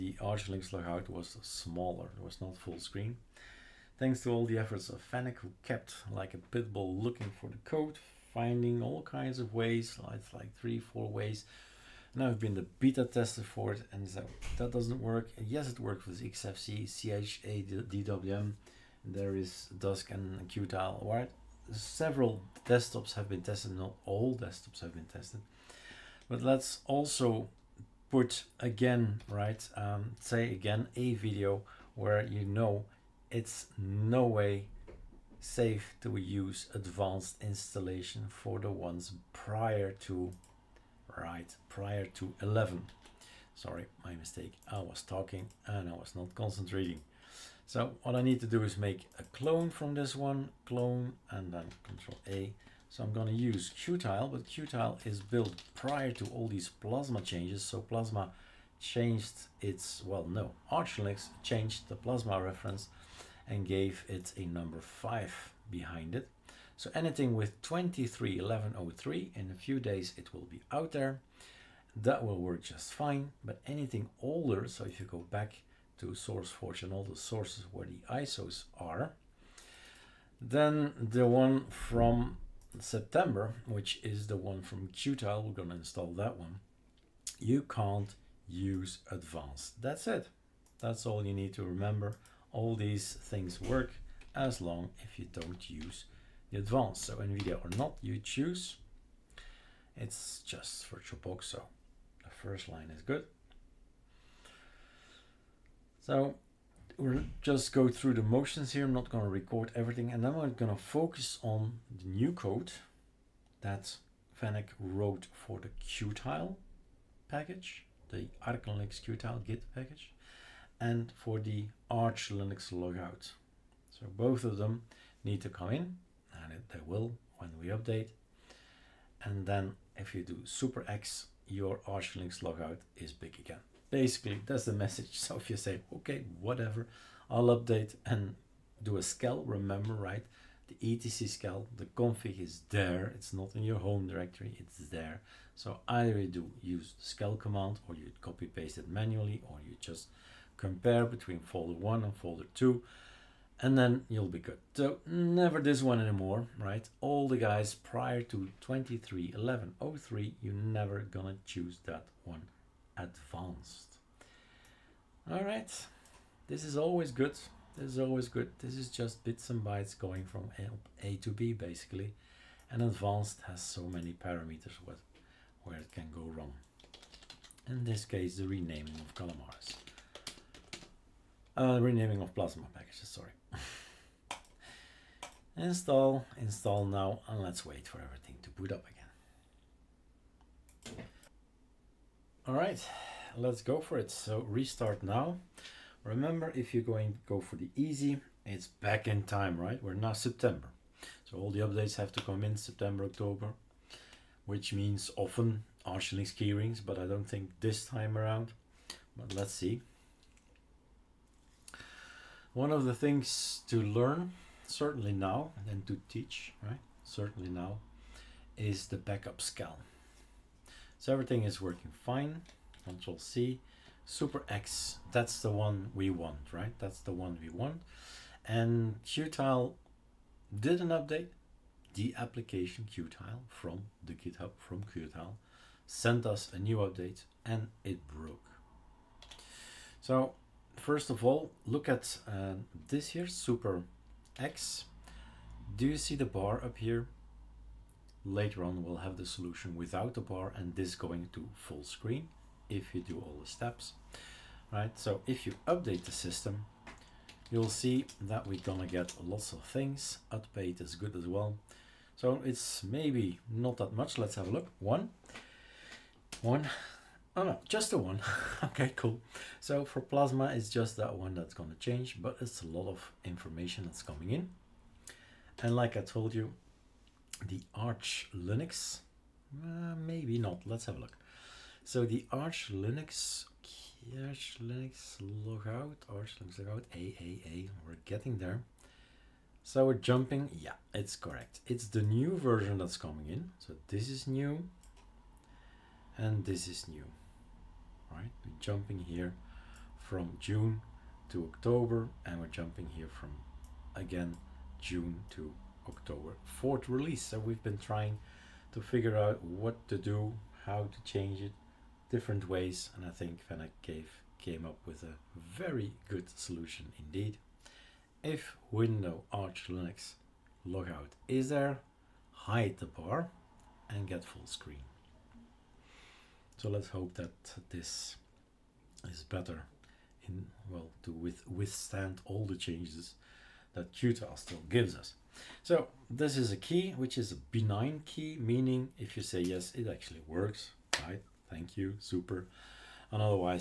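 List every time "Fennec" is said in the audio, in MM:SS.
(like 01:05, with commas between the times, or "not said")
00:05, 01:54, 05:13.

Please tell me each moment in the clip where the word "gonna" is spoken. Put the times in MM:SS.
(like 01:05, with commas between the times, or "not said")
01:25, 02:40, 04:18.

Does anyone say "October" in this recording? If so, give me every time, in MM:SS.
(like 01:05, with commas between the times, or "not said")
03:23, 05:01, 05:05.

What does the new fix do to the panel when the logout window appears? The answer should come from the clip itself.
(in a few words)
hide the bar.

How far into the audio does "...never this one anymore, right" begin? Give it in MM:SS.
02:35.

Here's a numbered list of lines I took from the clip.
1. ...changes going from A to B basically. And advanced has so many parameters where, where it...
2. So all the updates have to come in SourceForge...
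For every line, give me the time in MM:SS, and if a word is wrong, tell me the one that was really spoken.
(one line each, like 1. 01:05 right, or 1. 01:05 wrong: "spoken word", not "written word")
1. 02:49 wrong: "bytes", not "changes"
2. 03:21 wrong: "September", not "SourceForge".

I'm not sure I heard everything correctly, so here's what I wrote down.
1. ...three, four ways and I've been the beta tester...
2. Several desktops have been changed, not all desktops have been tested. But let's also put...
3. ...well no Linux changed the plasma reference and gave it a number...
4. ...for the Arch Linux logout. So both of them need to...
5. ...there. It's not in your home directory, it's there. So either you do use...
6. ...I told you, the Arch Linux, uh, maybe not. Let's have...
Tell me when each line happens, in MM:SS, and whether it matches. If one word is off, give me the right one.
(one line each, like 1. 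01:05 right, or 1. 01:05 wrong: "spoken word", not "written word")
1. 00:10 right
2. 00:21 wrong: "tested", not "changed"
3. 01:00 right
4. 02:01 right
5. 02:22 right
6. 04:35 right.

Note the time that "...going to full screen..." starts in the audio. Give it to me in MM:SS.
04:10.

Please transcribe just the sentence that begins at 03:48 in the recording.
And Qtile did an update, the application Qtile from the GitHub, from Qtile, sent us a new update and it broke.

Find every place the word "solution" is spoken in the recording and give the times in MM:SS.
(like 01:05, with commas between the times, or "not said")
04:09, 05:16.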